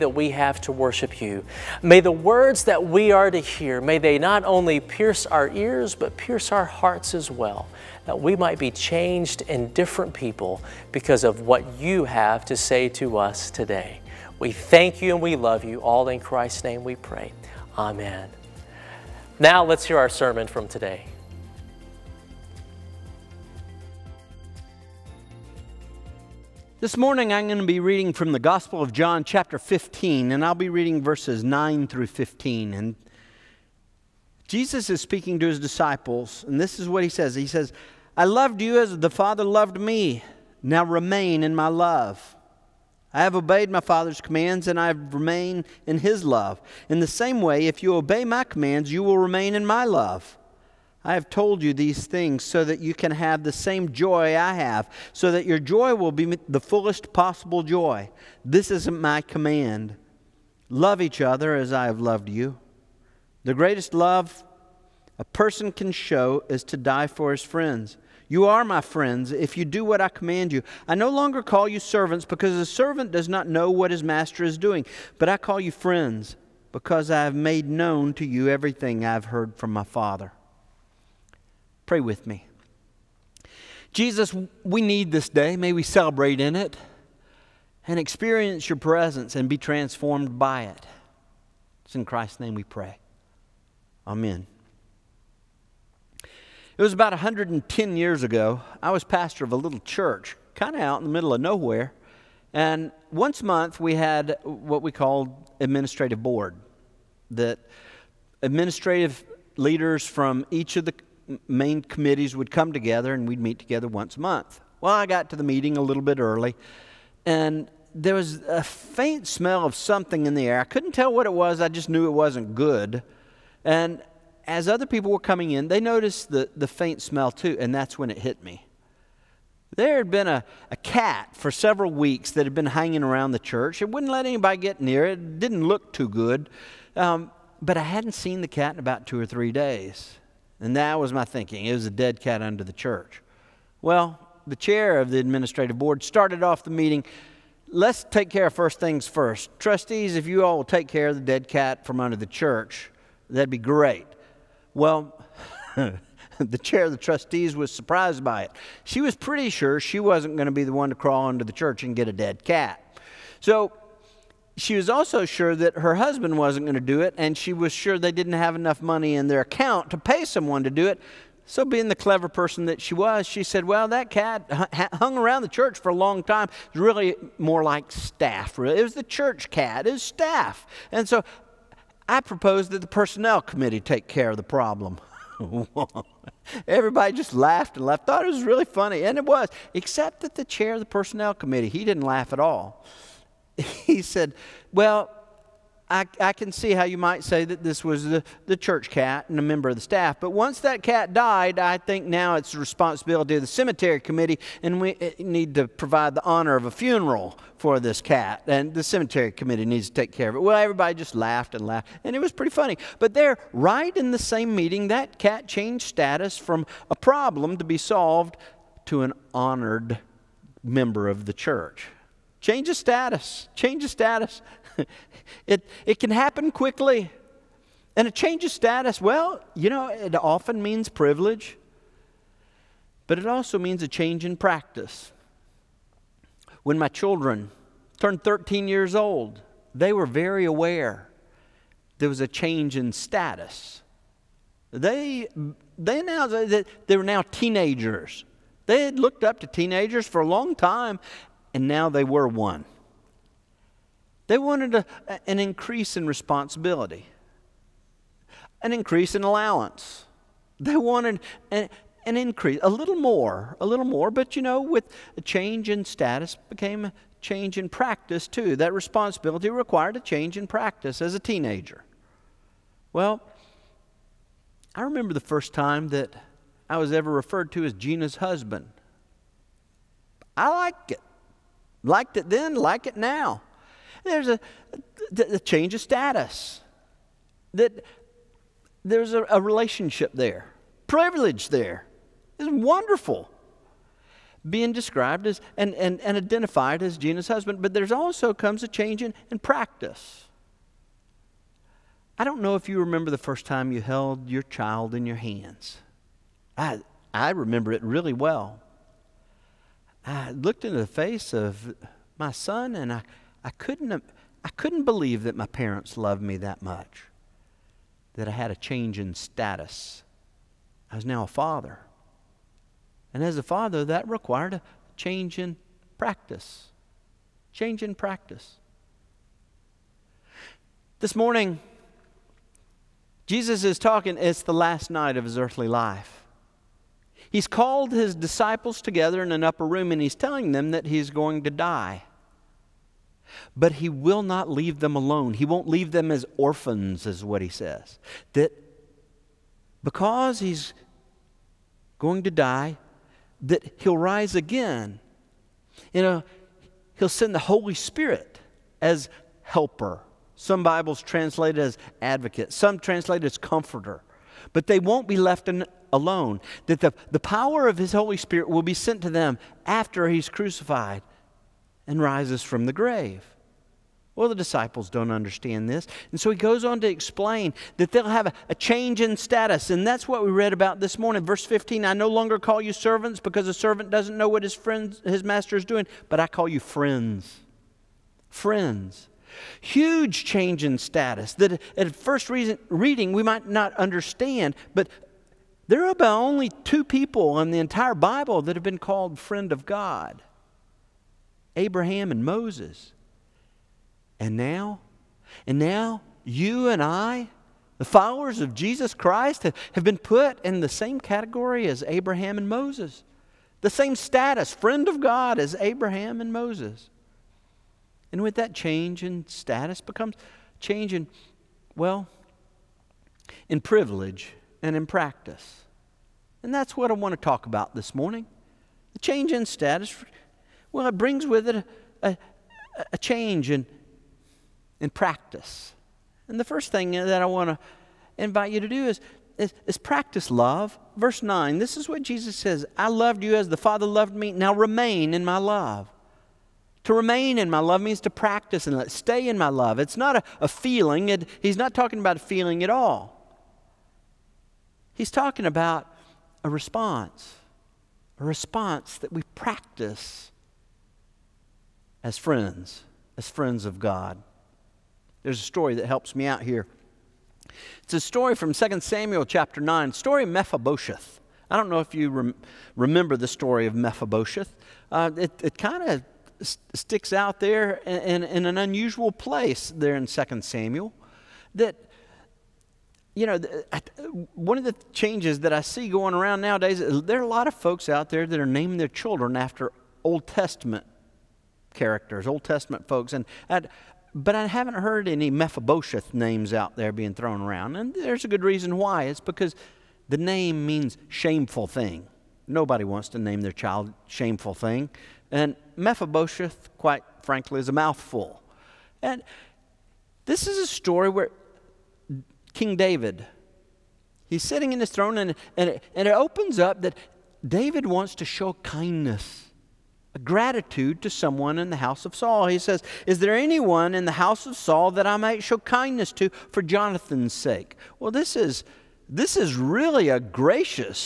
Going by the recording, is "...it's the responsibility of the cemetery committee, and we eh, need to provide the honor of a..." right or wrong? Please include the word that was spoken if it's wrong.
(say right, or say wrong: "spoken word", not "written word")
right.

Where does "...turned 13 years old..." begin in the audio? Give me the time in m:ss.
3:57.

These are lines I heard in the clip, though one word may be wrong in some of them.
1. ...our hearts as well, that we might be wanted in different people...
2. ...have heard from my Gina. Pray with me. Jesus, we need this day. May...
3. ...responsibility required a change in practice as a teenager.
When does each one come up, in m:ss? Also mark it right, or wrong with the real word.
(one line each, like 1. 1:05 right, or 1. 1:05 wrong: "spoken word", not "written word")
1. 0:06 wrong: "changed", not "wanted"
2. 1:19 wrong: "Father", not "Gina"
3. 4:28 right.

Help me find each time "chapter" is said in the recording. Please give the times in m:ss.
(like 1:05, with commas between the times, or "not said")
0:29, 7:49.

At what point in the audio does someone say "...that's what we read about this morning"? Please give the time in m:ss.
6:19.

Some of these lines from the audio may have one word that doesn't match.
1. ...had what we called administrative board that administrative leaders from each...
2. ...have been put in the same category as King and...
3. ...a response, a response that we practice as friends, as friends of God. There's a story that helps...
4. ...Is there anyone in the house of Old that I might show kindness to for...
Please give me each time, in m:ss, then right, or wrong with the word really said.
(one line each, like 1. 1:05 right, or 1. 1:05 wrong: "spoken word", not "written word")
1. 1:43 right
2. 6:49 wrong: "Abraham", not "King"
3. 7:36 right
4. 8:43 wrong: "Saul", not "Old".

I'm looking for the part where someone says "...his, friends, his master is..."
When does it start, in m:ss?
6:24.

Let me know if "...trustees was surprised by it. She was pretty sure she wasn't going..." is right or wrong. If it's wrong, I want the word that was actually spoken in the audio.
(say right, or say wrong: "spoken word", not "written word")
right.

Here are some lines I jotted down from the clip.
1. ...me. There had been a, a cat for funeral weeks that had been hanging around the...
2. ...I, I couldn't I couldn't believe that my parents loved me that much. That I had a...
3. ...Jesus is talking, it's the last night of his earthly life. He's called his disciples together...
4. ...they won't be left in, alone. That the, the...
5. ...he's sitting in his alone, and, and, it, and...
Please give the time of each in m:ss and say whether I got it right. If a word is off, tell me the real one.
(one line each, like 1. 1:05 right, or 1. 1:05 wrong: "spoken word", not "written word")
1. 2:08 wrong: "several", not "funeral"
2. 5:12 right
3. 5:33 right
4. 6:04 right
5. 8:34 wrong: "throne", not "alone".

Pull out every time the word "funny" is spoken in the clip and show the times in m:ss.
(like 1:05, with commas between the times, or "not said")
3:08, 3:32.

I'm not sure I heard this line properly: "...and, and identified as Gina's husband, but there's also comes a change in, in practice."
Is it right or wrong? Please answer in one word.
right.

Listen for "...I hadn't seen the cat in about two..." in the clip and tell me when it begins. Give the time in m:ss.
2:17.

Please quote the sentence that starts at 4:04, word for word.
They, they, now, they, they were now teenagers.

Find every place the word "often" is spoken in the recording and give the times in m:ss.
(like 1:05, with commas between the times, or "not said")
3:50.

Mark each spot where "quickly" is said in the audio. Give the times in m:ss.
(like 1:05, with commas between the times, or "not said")
3:46.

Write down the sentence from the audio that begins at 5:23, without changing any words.
And as a father, that required a change in practice.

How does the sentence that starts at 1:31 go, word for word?
It's in Christ's name we pray.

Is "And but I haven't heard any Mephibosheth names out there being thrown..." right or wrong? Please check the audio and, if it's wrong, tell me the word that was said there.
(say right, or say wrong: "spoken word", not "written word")
right.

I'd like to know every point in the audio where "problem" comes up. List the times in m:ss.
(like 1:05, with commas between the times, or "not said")
3:04, 3:36.